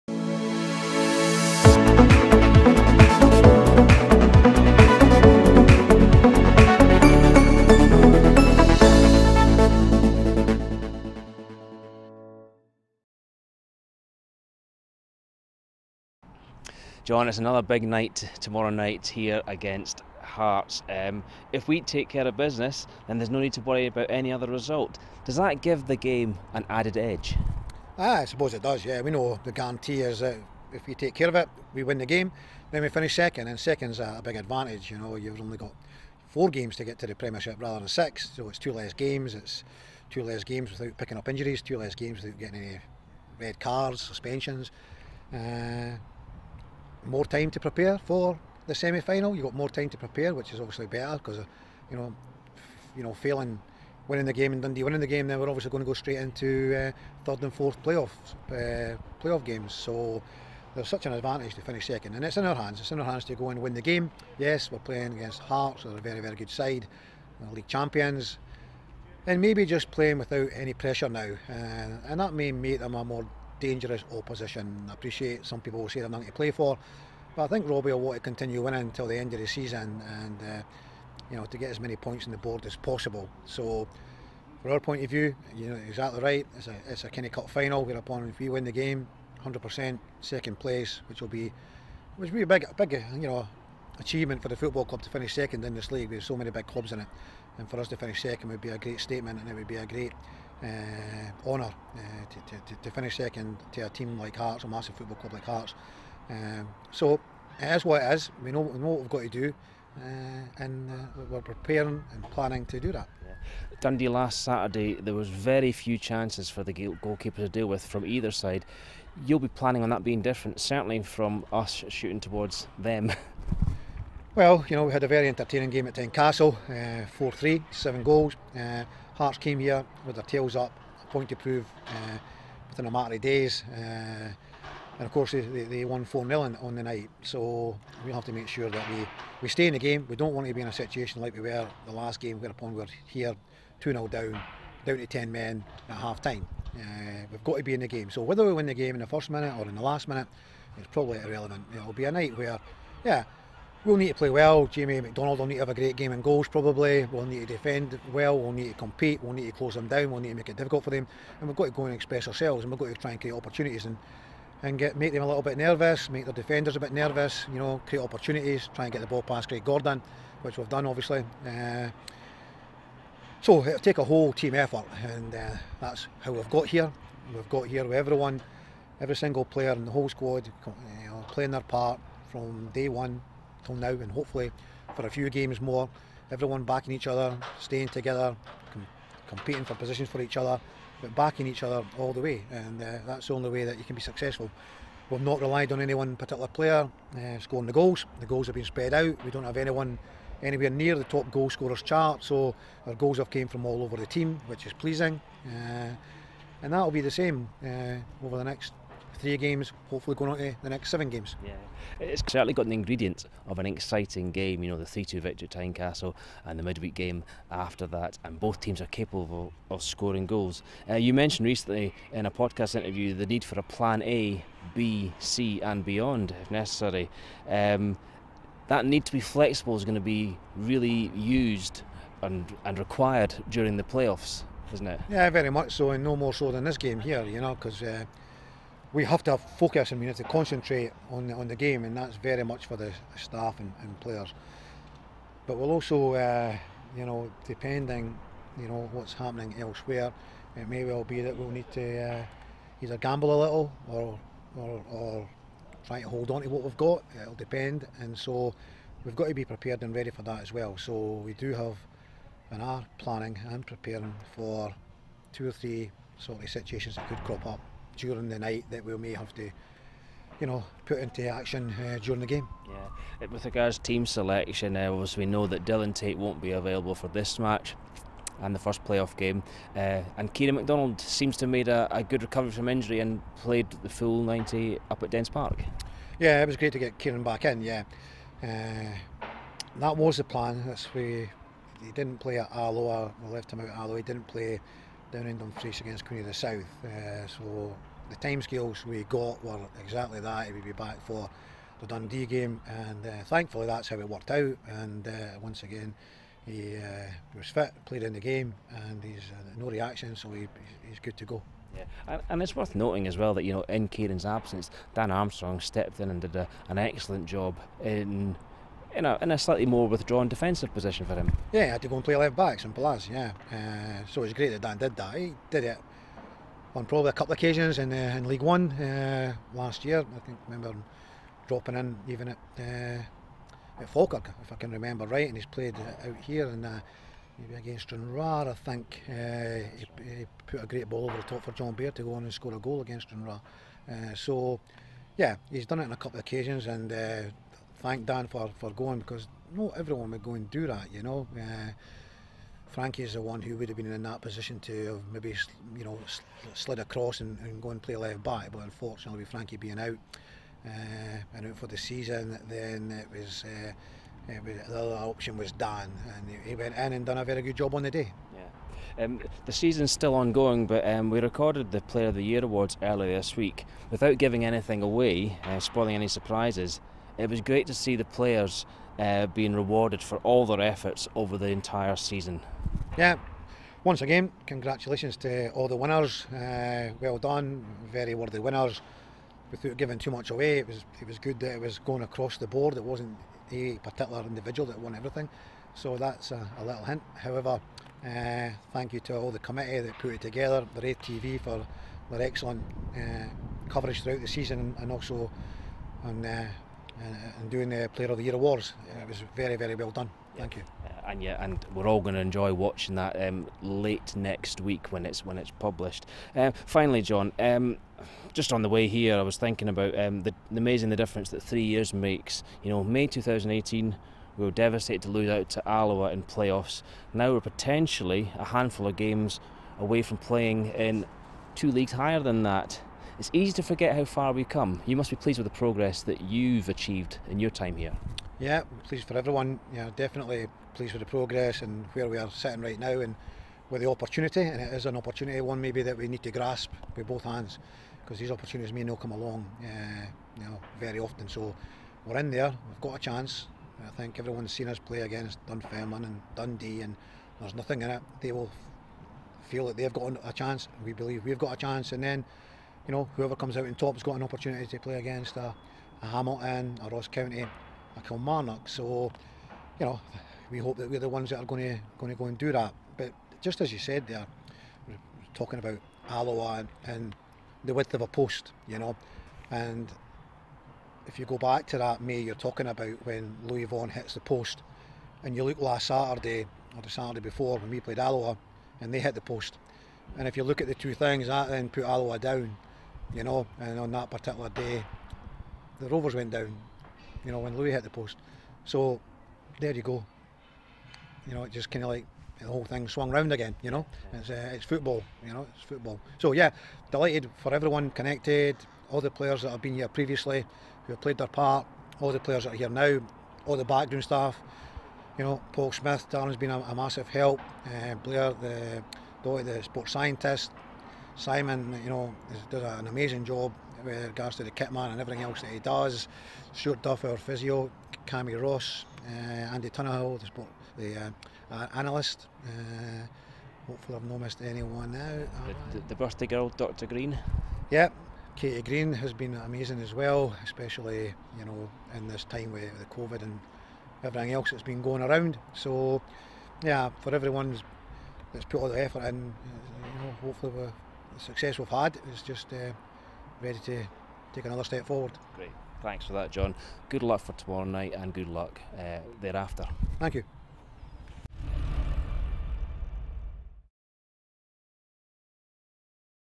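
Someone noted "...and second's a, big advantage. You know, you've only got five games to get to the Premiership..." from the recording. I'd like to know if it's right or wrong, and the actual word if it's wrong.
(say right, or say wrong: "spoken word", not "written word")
wrong: "four", not "five".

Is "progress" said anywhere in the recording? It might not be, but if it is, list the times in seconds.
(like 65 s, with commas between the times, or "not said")
435 s, 441 s.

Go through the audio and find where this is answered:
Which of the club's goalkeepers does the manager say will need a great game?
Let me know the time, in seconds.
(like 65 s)
154 s.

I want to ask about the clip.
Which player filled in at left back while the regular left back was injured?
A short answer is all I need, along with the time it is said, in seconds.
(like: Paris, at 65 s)
Dan Armstrong, at 314 s.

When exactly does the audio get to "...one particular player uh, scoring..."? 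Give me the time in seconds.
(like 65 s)
195 s.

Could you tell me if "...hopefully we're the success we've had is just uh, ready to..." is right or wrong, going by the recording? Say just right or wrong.
right.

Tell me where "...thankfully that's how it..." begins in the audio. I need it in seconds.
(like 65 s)
303 s.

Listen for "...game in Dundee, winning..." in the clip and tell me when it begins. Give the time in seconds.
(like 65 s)
54 s.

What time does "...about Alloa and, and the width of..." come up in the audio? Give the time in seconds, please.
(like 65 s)
475 s.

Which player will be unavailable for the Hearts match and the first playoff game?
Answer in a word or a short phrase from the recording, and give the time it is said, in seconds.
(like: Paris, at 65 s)
Dylan Tait, at 275 s.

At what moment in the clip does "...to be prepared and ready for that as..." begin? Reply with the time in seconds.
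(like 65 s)
259 s.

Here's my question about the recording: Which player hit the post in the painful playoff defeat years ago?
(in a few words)
Lewis Vaughan.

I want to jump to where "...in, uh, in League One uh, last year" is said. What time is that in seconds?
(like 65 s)
327 s.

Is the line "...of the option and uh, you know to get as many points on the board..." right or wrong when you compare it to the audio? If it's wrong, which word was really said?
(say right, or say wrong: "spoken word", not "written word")
wrong: "season", not "option".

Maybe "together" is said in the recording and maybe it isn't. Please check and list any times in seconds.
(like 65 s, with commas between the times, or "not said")
187 s, 400 s.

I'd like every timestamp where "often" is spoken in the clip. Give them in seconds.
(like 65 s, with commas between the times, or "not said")
450 s.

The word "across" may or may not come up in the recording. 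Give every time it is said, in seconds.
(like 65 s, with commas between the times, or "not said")
356 s, 392 s.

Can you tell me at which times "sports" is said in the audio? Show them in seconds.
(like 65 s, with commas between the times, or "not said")
519 s, 530 s.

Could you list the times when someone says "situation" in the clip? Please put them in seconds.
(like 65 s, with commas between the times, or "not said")
140 s, 266 s.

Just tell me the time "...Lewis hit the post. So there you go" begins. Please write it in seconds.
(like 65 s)
497 s.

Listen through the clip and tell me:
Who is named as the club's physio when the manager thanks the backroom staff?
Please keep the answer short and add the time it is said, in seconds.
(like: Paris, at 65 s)
Stuart Duff, at 526 s.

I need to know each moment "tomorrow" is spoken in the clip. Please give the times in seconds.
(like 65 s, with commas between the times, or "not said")
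18 s, 557 s.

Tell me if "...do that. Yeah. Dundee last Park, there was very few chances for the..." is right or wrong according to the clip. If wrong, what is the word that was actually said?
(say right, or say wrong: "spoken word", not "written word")
wrong: "Saturday", not "Park".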